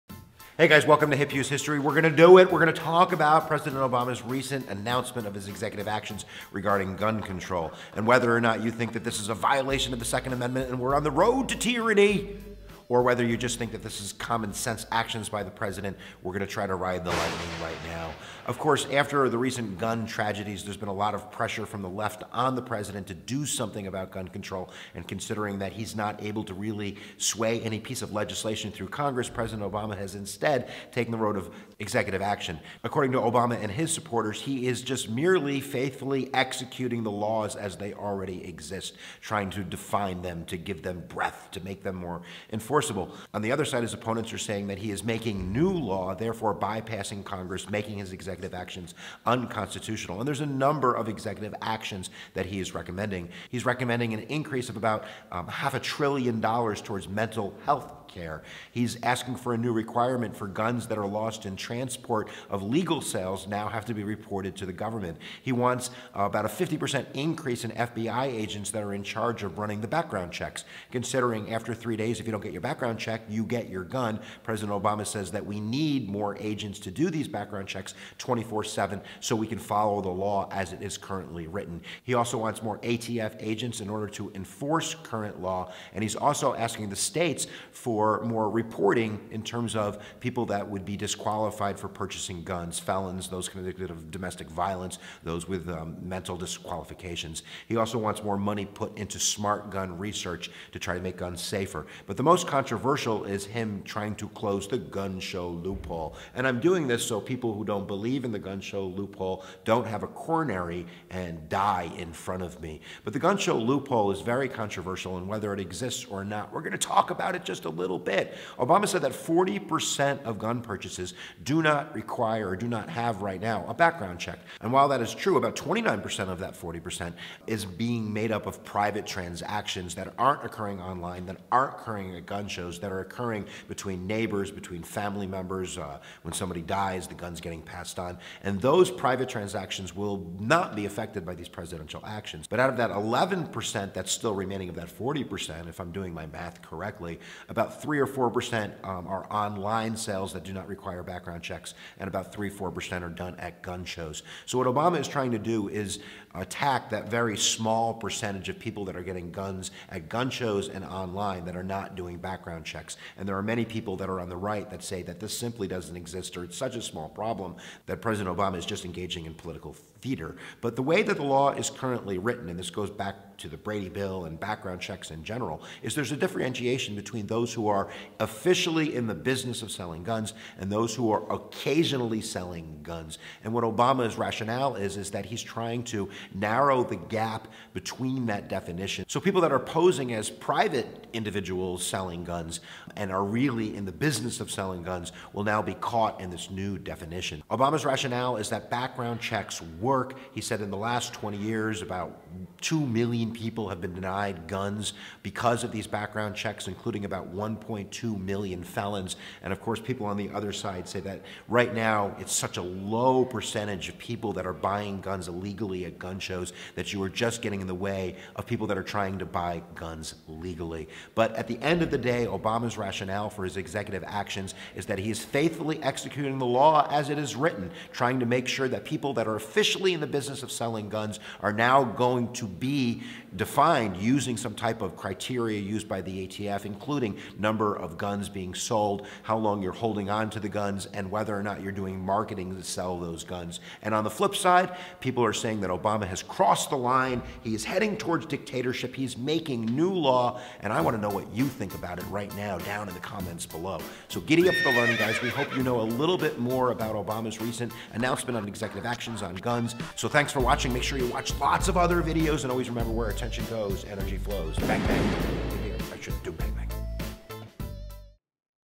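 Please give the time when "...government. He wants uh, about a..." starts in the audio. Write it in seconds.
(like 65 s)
64 s.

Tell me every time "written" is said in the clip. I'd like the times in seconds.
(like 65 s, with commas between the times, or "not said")
81 s, 172 s, 227 s.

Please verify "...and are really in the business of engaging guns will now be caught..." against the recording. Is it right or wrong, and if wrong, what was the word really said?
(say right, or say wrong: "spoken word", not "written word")
wrong: "selling", not "engaging".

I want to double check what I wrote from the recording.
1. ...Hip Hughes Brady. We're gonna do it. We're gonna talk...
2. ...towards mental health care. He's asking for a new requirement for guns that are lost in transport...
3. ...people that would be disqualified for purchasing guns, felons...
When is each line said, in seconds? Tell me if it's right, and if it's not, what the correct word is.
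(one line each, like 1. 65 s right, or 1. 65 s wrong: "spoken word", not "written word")
1. 1 s wrong: "History", not "Brady"
2. 56 s right
3. 90 s right.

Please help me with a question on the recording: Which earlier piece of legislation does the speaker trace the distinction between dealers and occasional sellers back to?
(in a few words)
Brady bill.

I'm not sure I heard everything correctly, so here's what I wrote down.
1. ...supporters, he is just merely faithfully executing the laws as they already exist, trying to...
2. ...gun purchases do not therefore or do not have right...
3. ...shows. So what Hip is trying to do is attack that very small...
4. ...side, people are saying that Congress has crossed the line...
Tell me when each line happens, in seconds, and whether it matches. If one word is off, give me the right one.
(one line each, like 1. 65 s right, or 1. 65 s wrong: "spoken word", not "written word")
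1. 33 s right
2. 120 s wrong: "require", not "therefore"
3. 153 s wrong: "Obama", not "Hip"
4. 244 s wrong: "Obama", not "Congress".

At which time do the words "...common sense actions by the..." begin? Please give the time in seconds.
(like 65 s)
14 s.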